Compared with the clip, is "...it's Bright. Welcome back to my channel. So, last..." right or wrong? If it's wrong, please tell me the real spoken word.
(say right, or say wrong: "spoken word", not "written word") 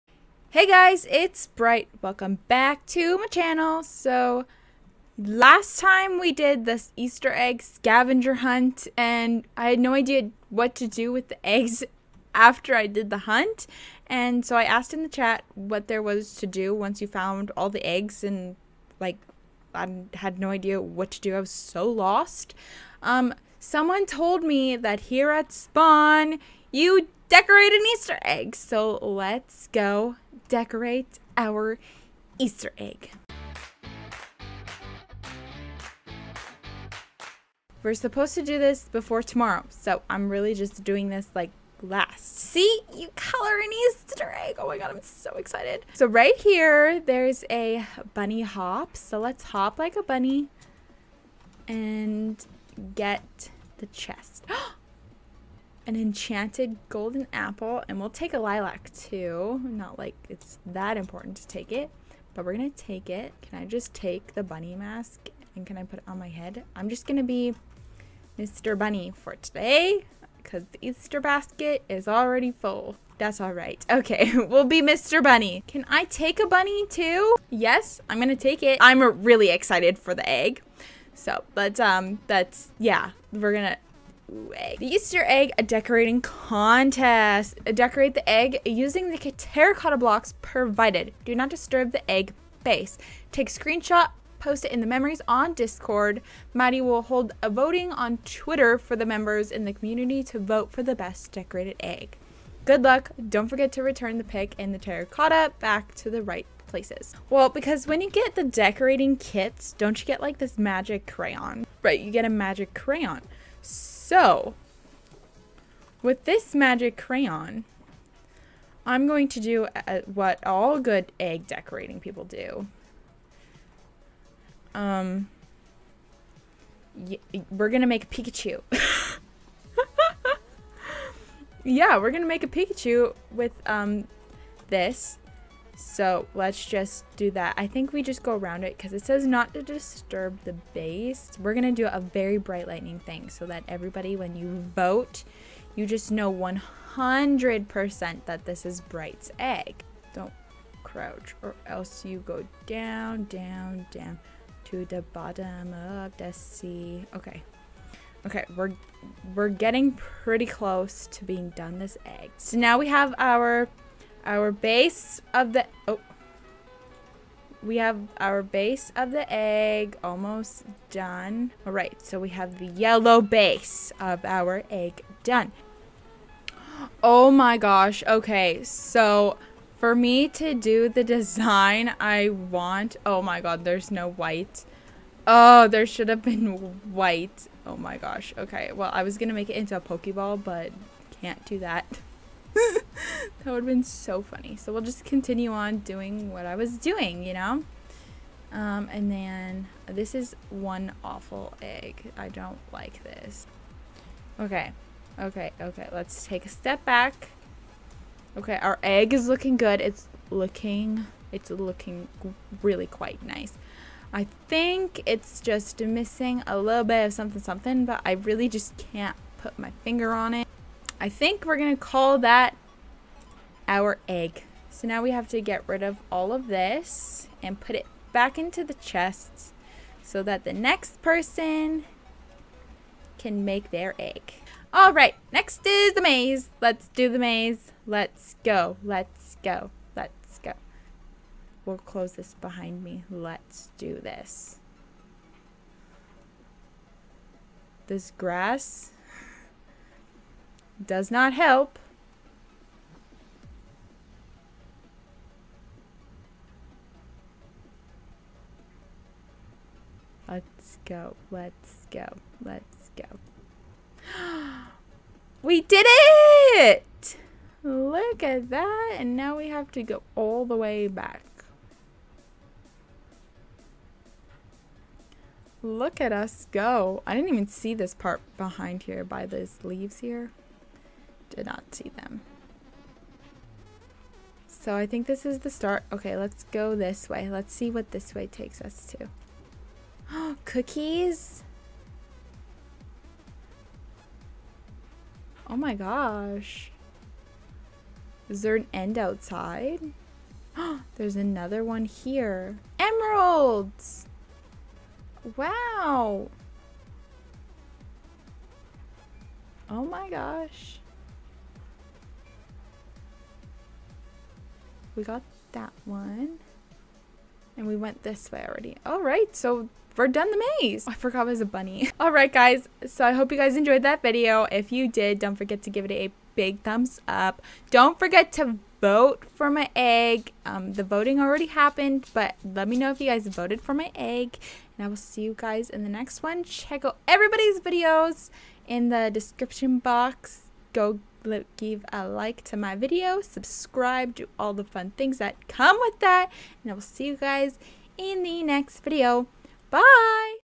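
right.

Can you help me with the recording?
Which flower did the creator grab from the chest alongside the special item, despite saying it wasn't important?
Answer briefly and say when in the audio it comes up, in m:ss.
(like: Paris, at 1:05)
Lilac, at 0:58.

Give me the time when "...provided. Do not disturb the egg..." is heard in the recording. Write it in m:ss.
1:30.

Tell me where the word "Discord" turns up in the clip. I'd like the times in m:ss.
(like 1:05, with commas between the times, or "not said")
1:35.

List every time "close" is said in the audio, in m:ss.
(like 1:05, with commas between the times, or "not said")
2:40, 4:01.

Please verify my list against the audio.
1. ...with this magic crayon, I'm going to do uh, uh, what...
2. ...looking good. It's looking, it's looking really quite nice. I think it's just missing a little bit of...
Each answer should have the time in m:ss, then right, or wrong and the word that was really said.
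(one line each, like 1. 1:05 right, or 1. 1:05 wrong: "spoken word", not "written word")
1. 1:56 right
2. 3:29 right.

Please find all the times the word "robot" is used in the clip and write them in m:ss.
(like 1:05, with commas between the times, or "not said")
not said.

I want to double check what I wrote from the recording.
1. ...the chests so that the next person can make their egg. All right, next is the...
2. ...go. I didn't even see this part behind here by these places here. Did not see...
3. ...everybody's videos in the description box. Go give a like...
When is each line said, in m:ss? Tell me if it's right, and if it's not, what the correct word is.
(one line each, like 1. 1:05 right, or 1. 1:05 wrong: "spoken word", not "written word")
1. 3:48 right
2. 4:36 wrong: "leaves", not "places"
3. 5:37 right.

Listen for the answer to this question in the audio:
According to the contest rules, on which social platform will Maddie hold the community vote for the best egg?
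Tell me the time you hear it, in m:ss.
1:38.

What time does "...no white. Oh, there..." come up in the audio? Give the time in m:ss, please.
3:03.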